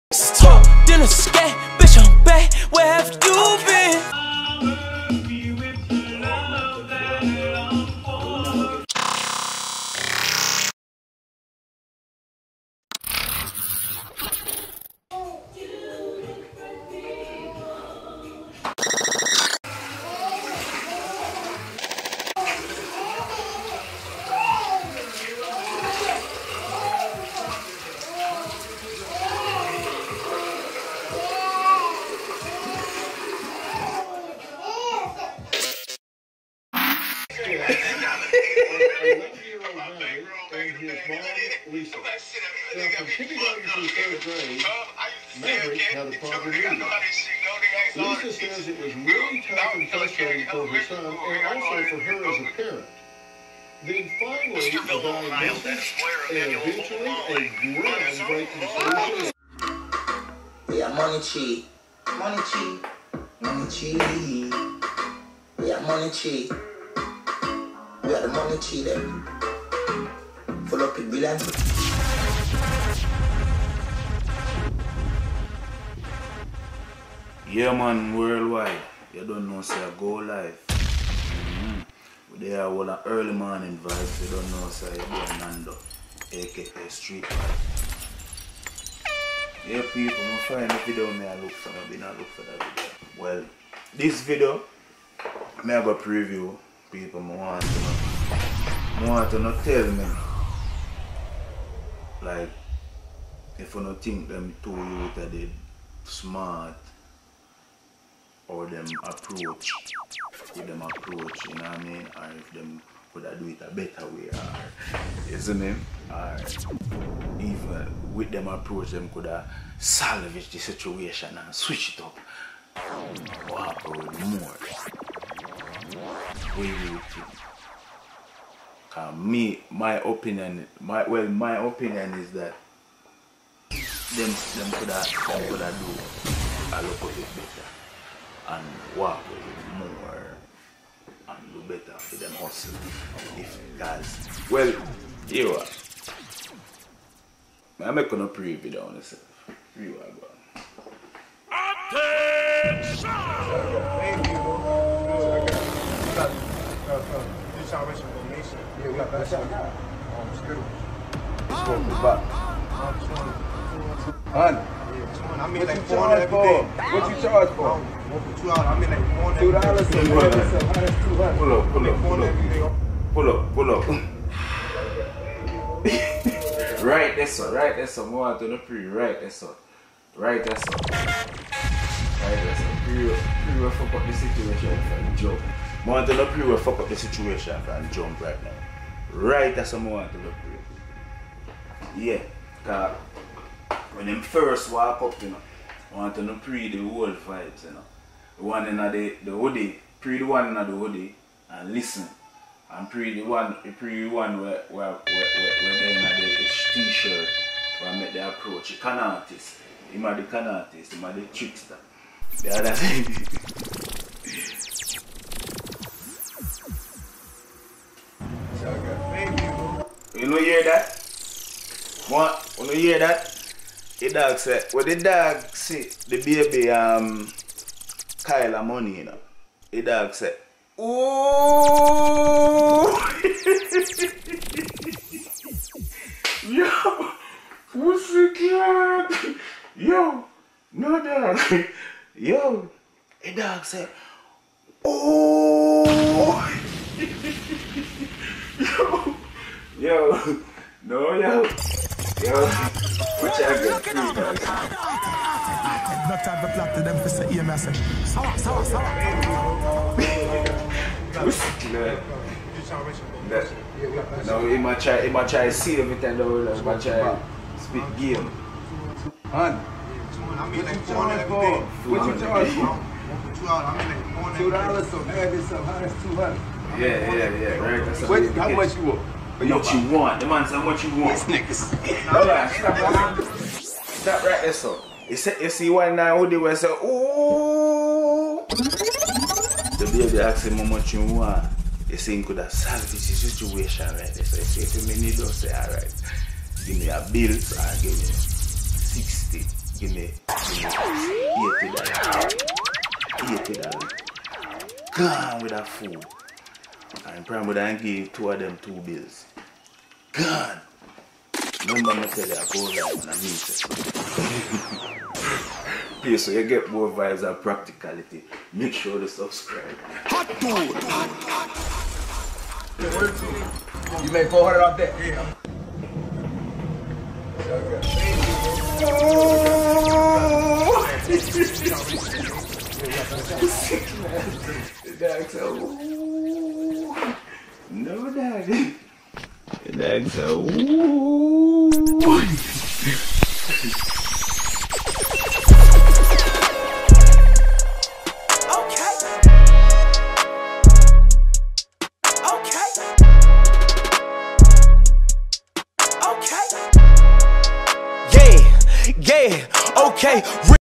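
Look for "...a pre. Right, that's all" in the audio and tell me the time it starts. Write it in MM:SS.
02:58.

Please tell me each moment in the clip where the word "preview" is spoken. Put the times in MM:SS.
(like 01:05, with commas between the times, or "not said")
01:35, 02:28.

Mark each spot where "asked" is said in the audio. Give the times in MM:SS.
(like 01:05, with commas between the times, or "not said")
04:50.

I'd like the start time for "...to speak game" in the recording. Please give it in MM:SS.
04:26.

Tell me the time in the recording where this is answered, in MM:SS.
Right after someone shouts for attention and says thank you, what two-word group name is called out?
02:37.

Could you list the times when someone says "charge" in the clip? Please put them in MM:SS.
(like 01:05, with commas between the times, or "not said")
02:45, 04:32.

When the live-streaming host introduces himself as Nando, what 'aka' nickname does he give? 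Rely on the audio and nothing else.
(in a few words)
Street Vibe.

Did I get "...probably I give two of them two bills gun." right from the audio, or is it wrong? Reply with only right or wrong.
right.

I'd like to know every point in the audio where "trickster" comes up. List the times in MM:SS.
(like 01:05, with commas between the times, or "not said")
03:31.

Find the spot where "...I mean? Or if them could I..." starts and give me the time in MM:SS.
01:51.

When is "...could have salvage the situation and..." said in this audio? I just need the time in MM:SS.
01:59.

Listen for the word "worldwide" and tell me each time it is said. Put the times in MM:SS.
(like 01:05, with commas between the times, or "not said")
01:18.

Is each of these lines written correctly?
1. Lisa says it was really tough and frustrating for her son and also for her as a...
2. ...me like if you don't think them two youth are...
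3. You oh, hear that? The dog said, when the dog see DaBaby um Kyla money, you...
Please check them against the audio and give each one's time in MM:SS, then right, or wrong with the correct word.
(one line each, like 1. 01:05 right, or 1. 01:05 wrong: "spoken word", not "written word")
1. 00:47 right
2. 01:39 right
3. 03:42 right.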